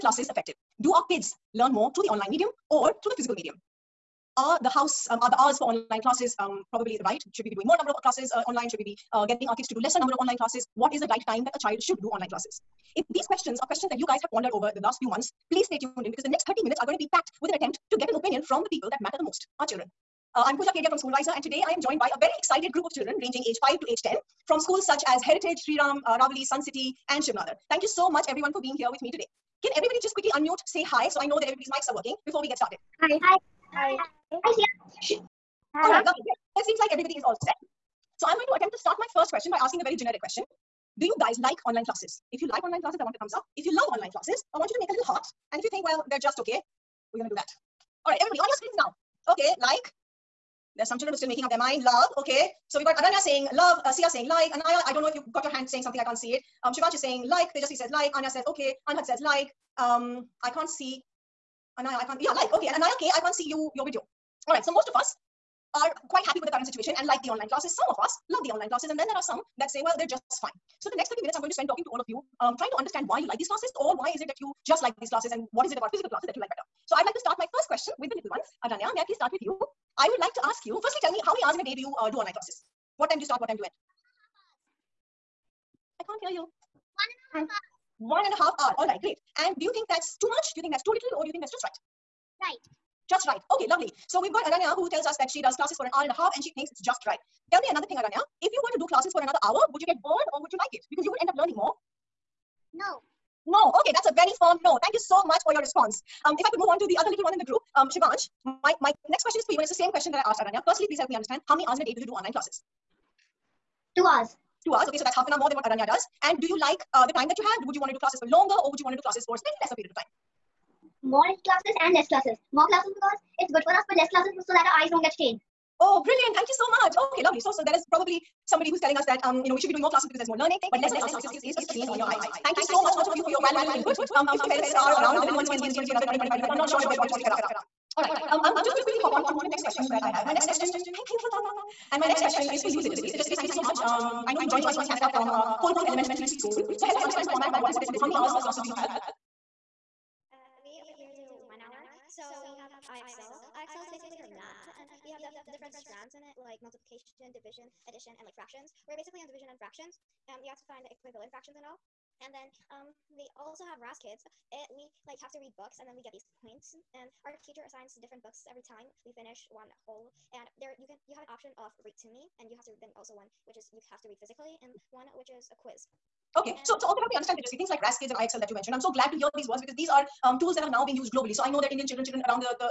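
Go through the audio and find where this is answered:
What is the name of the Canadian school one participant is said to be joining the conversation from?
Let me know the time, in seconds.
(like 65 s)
145 s.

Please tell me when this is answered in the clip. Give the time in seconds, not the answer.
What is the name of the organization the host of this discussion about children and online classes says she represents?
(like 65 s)
20 s.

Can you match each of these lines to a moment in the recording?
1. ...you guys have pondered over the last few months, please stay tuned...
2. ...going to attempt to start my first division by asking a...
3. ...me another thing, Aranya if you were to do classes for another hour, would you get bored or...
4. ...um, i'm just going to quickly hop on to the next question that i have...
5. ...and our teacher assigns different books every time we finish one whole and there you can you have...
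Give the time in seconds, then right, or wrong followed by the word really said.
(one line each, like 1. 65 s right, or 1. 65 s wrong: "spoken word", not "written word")
1. 13 s right
2. 38 s wrong: "question", not "division"
3. 97 s right
4. 138 s right
5. 166 s right.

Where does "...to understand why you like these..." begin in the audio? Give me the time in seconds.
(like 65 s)
72 s.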